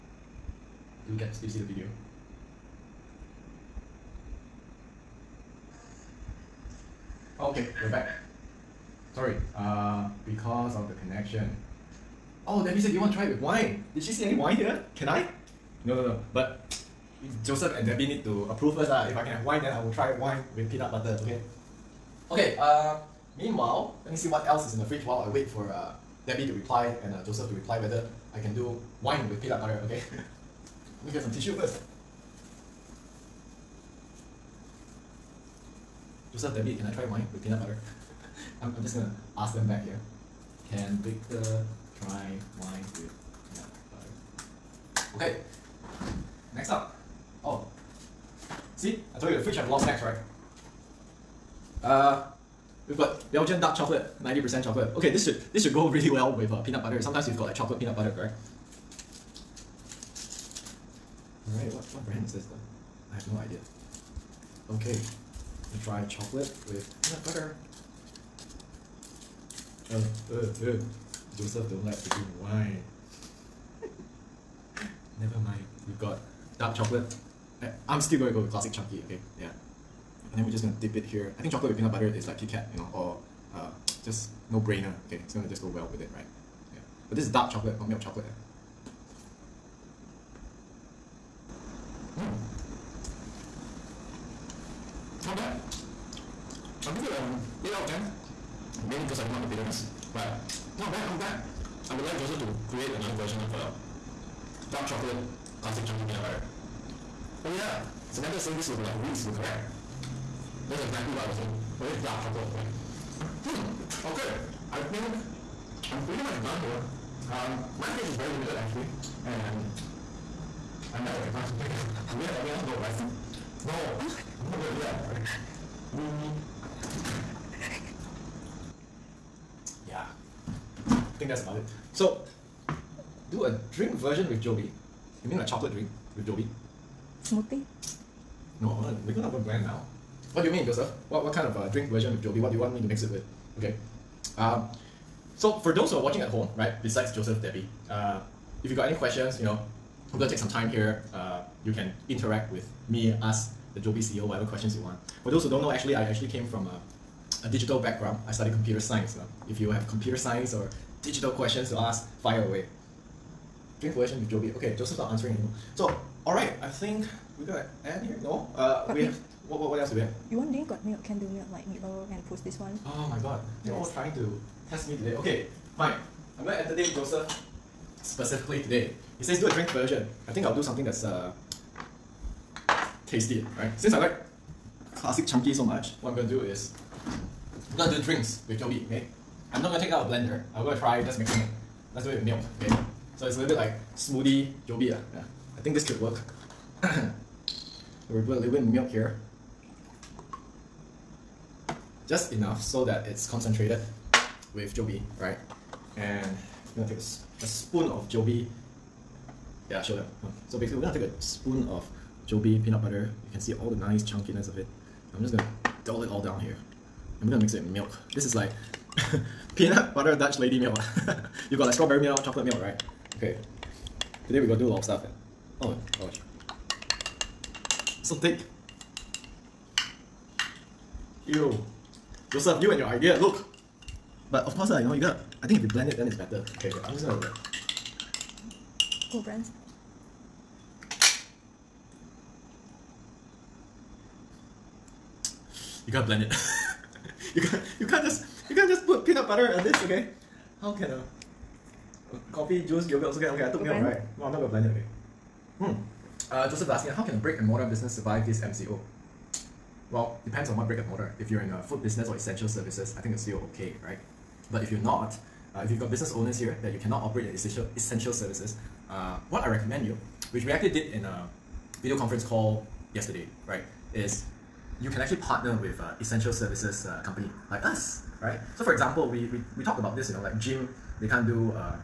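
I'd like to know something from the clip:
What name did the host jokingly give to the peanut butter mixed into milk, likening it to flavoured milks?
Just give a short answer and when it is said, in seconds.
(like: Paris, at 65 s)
Peanut butter Dutch Lady milk, at 219 s.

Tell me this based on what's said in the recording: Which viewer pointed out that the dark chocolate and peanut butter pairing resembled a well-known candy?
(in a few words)
Samantha.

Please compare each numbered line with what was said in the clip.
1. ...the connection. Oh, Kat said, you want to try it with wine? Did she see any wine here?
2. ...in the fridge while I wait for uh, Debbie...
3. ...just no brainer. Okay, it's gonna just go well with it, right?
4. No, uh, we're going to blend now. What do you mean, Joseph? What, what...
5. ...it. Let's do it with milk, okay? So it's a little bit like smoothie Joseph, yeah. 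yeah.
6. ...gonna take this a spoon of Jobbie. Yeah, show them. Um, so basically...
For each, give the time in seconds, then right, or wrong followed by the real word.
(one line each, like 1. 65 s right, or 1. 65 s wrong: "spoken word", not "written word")
1. 10 s wrong: "Debbie", not "Kat"
2. 24 s right
3. 84 s right
4. 138 s right
5. 191 s wrong: "Jobbie", not "Joseph"
6. 206 s right.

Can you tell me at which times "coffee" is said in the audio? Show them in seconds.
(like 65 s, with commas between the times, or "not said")
252 s.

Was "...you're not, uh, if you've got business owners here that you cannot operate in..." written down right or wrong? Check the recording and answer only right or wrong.
right.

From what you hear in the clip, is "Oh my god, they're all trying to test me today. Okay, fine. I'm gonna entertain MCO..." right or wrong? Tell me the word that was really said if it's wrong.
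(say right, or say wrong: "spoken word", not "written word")
wrong: "Joseph", not "MCO".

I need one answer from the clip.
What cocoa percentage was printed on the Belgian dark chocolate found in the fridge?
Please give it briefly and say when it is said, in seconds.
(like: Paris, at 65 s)
90%, at 54 s.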